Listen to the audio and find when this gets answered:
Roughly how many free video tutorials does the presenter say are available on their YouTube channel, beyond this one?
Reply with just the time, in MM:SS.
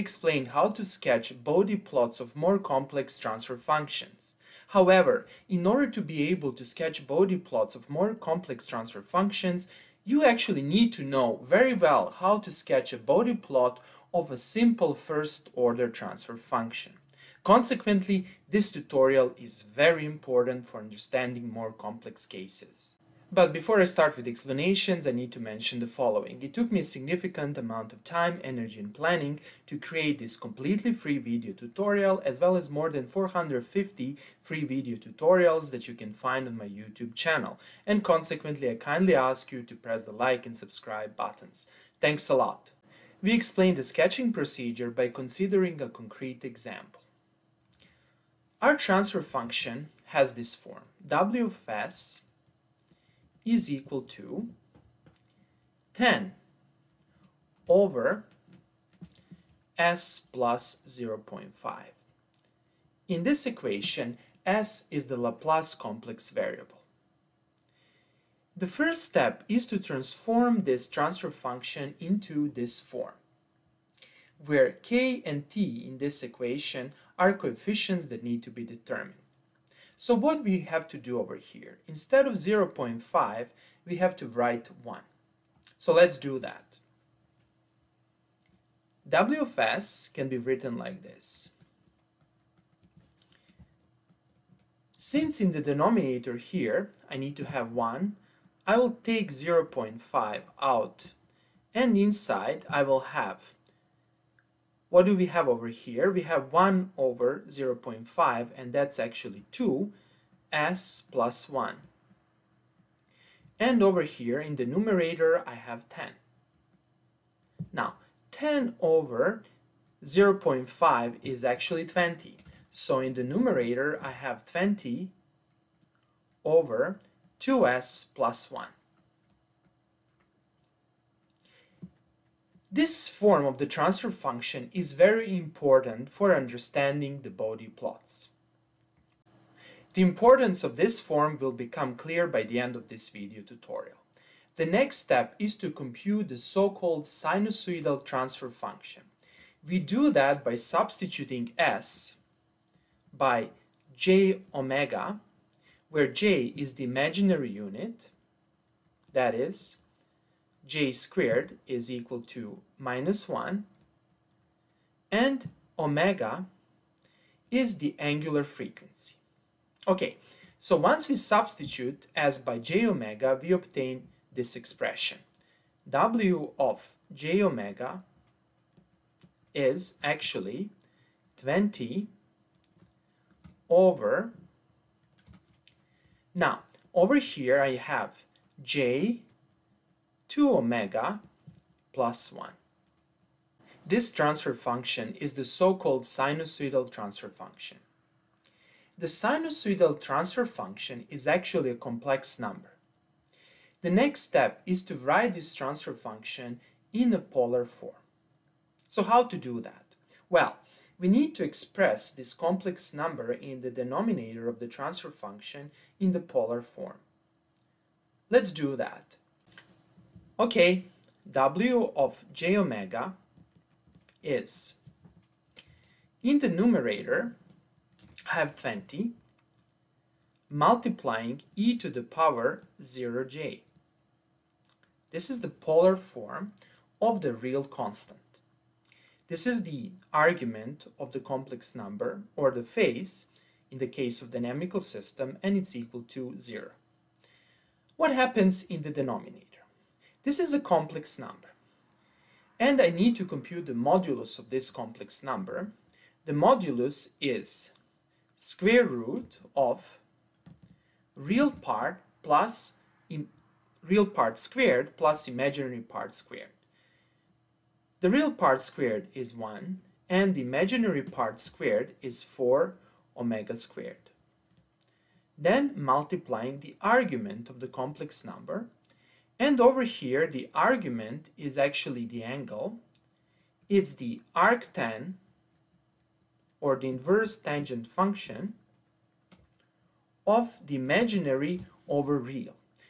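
00:32.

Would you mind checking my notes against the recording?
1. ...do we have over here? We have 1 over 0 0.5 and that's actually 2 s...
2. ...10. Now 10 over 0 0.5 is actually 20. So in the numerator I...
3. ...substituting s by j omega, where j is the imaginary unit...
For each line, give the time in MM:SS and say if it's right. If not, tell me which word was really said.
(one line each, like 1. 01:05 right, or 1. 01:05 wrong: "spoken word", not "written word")
1. 01:45 right
2. 01:55 right
3. 02:30 right.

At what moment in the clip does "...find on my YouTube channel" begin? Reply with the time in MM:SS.
00:36.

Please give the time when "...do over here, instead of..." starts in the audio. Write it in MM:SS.
01:20.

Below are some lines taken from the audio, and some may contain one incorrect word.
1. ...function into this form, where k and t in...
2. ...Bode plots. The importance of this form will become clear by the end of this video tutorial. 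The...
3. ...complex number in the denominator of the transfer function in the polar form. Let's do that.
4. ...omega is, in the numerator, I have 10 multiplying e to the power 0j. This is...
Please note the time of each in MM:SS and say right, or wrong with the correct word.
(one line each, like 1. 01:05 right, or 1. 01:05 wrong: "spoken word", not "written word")
1. 01:11 right
2. 02:17 right
3. 03:32 right
4. 03:42 wrong: "20", not "10".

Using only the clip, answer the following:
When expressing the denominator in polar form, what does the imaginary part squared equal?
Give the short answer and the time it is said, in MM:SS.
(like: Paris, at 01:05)
4 omega squared, at 04:32.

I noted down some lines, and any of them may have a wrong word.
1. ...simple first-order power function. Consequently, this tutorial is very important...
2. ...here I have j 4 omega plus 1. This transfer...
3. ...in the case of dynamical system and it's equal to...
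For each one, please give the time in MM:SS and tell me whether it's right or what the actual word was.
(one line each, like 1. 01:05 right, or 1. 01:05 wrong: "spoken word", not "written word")
1. 00:14 wrong: "transfer", not "power"
2. 03:07 wrong: "2", not "4"
3. 04:03 right.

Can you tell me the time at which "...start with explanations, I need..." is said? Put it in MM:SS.
00:23.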